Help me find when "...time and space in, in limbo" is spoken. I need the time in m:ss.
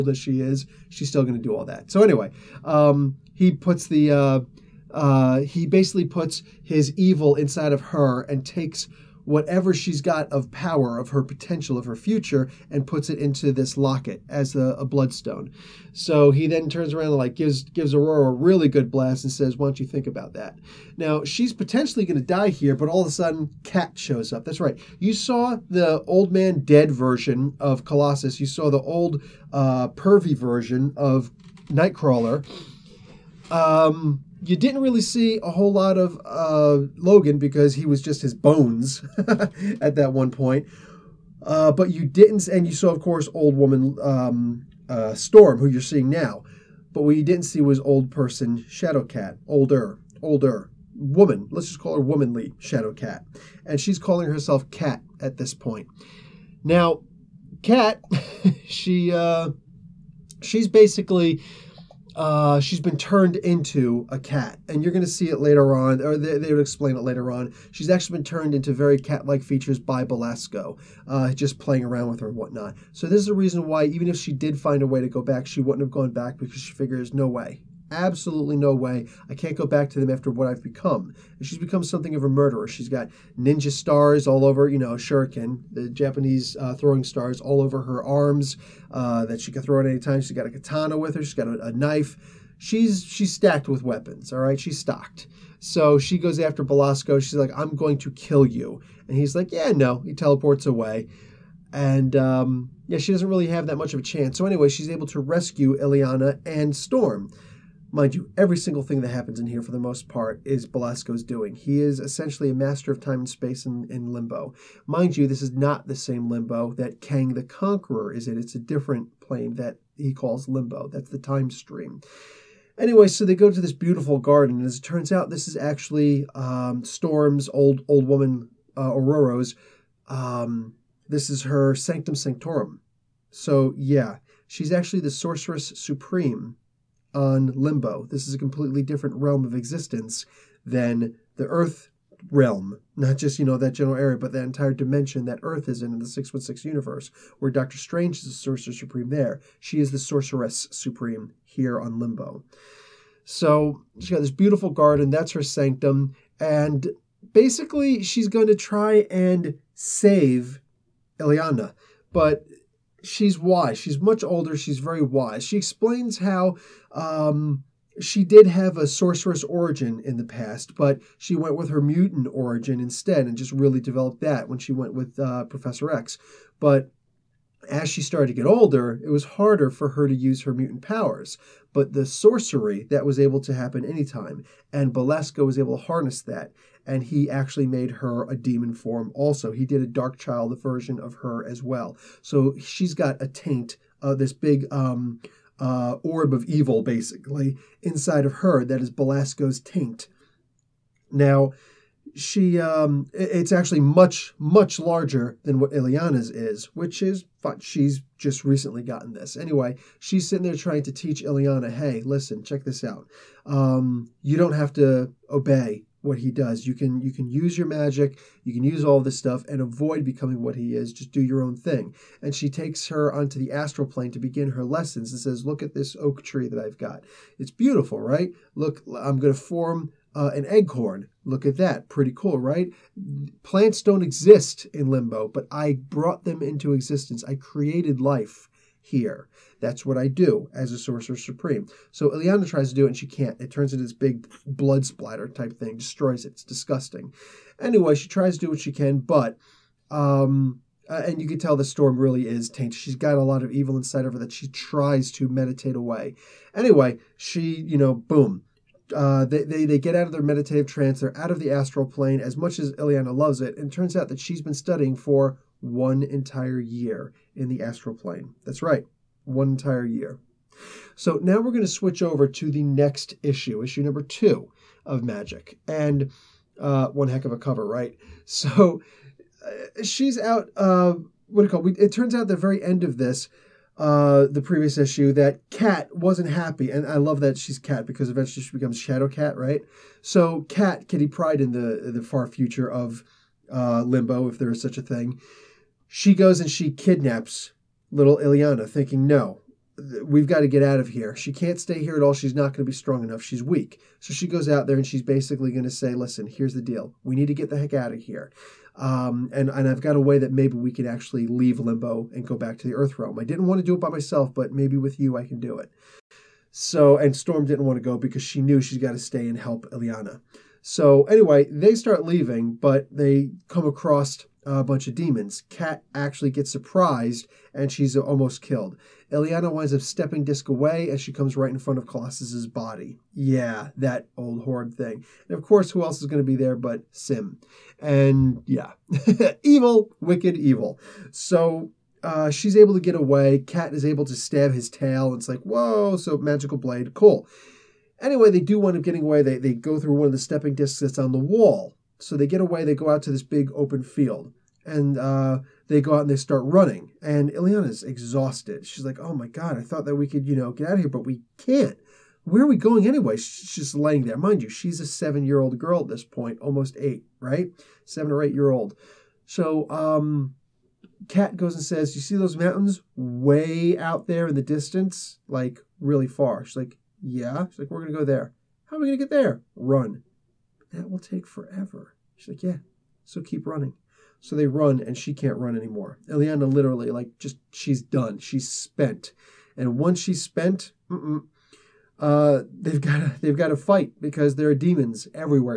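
1:52.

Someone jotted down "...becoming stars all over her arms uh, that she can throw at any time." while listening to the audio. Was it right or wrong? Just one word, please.
wrong.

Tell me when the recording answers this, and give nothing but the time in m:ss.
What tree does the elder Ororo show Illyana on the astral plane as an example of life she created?
3:45.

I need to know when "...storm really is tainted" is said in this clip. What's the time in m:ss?
4:11.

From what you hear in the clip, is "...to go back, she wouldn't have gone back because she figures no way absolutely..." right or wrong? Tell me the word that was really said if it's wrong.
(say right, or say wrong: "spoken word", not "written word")
right.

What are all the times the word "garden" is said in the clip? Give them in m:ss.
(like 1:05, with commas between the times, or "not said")
2:04, 2:34.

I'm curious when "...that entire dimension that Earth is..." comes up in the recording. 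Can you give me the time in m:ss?
2:24.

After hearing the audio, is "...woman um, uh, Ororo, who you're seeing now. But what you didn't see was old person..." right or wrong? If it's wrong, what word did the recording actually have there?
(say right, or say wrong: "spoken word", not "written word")
wrong: "Storm", not "Ororo".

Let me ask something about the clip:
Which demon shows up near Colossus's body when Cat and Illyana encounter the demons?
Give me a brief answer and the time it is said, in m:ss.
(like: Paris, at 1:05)
S'ym, at 5:36.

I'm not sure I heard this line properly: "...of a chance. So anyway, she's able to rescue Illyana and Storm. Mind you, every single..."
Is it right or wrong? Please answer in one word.
right.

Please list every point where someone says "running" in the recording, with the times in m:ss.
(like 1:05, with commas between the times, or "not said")
5:56, 6:23.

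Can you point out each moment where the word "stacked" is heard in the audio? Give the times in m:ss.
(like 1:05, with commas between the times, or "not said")
1:33.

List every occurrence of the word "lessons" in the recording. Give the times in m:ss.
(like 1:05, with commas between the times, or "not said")
3:44.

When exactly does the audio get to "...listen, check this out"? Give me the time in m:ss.
3:32.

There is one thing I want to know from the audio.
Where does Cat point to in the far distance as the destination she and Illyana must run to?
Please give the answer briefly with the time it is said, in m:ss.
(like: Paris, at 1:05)
mountains, at 6:12.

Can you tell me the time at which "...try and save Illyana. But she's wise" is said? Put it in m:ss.
2:38.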